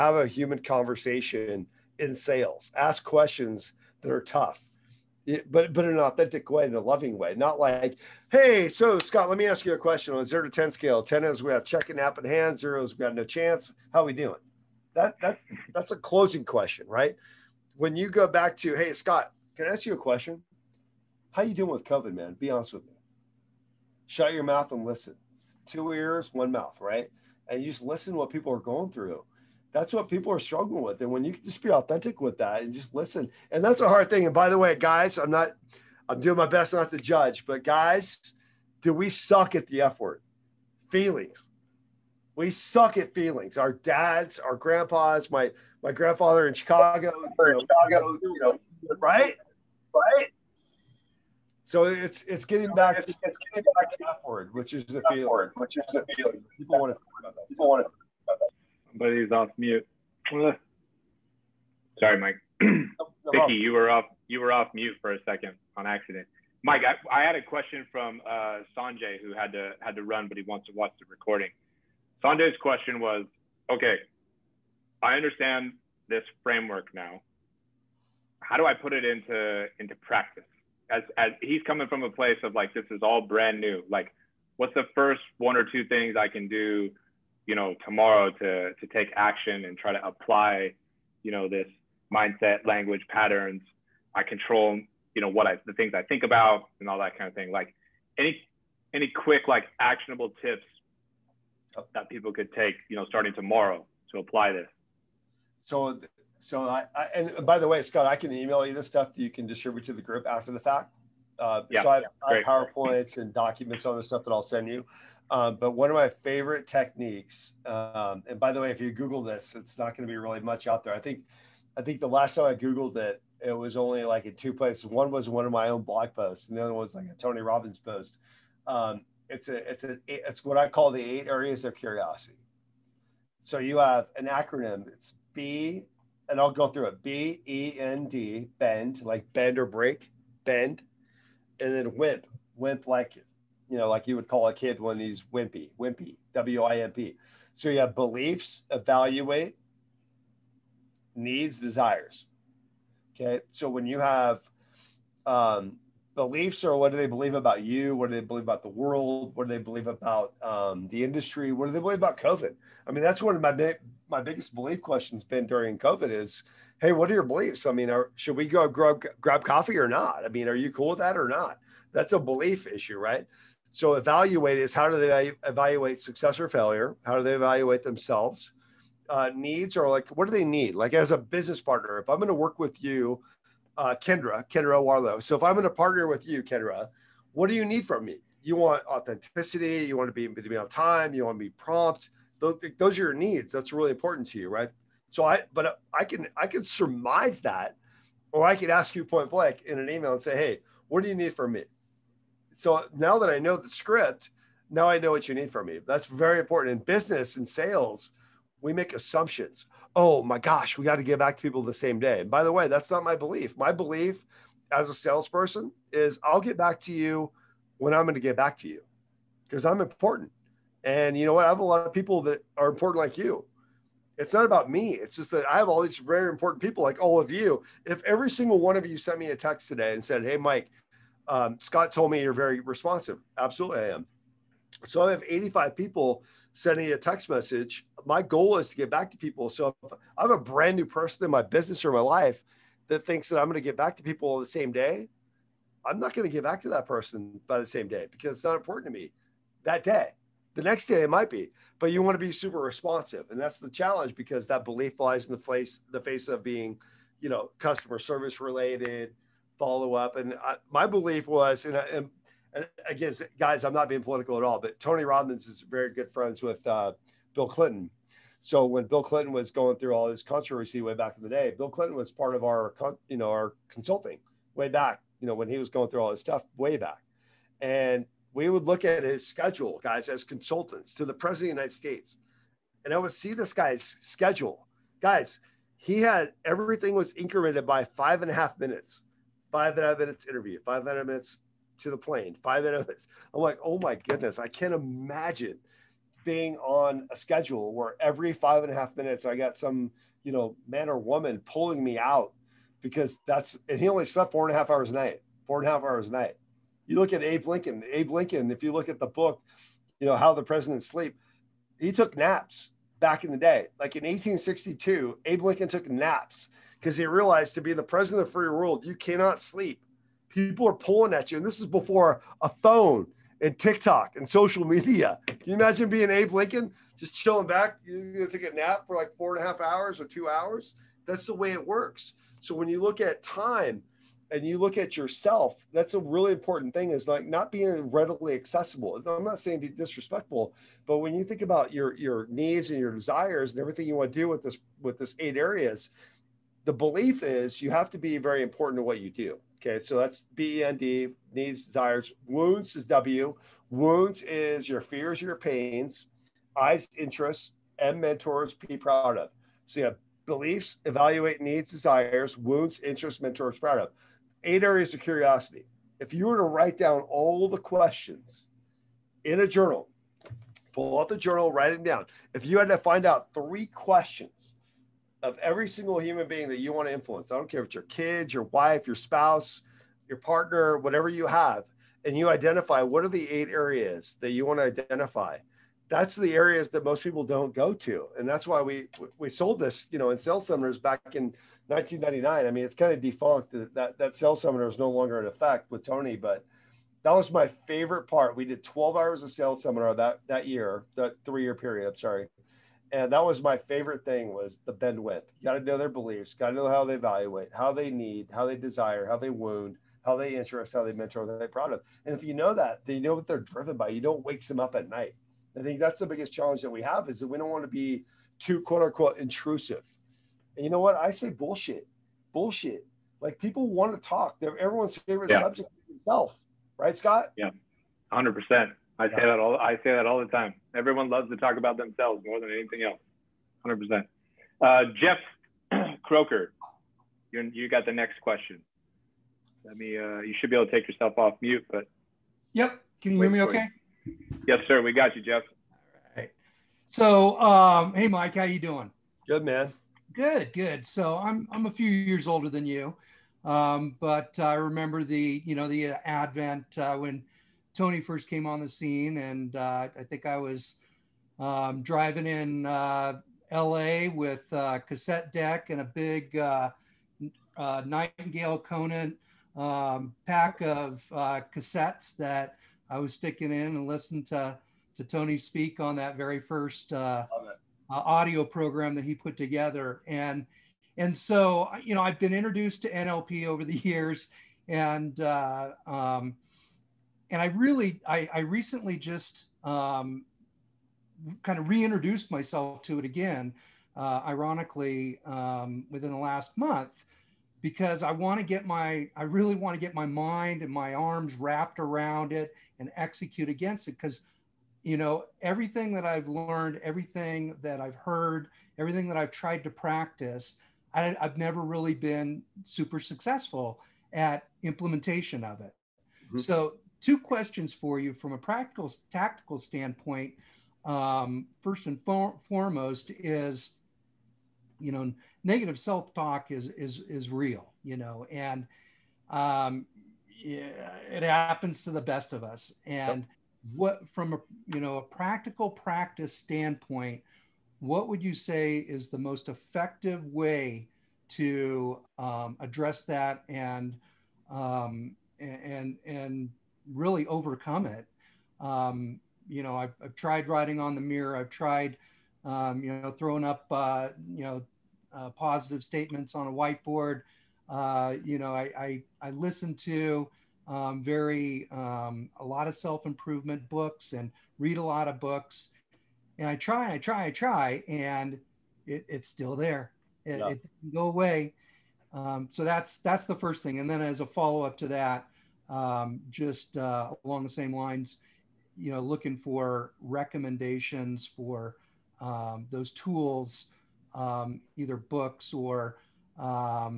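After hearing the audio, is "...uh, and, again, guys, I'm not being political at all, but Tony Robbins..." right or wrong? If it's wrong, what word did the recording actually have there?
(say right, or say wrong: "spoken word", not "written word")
right.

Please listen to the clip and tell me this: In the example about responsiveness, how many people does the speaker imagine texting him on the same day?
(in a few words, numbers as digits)
85.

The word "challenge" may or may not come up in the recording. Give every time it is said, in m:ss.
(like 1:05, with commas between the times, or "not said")
4:13, 6:56.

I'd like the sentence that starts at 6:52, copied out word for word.
And if you know that, then you know what they're driven by.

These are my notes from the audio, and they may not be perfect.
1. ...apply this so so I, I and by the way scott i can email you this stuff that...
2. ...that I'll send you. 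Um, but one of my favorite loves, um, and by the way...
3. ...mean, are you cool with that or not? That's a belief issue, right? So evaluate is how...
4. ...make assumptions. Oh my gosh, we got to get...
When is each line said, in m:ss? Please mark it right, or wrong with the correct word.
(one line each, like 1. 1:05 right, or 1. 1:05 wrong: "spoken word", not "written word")
1. 1:44 right
2. 1:54 wrong: "techniques", not "loves"
3. 2:50 right
4. 3:28 right.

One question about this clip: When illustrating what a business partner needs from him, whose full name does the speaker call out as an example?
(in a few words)
Kendra Warlow.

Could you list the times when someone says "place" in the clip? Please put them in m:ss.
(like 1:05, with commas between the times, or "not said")
1:22, 2:04.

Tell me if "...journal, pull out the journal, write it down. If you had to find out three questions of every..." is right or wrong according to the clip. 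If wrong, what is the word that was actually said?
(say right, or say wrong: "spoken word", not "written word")
right.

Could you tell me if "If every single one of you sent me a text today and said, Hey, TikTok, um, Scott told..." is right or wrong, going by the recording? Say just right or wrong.
wrong.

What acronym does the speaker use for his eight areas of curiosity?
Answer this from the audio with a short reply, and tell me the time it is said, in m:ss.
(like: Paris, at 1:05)
BEND WIMP, at 6:44.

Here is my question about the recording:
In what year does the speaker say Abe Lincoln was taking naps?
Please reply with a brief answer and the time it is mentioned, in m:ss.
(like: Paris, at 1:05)
1862, at 5:14.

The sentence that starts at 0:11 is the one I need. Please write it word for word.
Ten is we have check and app in hand.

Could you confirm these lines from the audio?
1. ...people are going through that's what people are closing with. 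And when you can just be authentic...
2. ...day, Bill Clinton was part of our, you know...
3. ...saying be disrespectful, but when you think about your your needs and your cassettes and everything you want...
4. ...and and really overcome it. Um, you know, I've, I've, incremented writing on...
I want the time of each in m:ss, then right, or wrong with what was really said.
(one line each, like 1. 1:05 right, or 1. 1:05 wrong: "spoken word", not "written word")
1. 0:28 wrong: "struggling", not "closing"
2. 4:31 right
3. 5:39 wrong: "desires", not "cassettes"
4. 9:05 wrong: "tried", not "incremented".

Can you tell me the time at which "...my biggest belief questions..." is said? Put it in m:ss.
2:44.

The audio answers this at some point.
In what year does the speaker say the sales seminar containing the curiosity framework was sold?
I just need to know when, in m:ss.
6:31.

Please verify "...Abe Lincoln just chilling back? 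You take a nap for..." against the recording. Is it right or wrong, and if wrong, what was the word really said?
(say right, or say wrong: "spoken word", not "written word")
right.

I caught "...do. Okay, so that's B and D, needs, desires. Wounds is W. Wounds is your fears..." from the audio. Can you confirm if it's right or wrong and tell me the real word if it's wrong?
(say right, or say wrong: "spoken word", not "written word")
right.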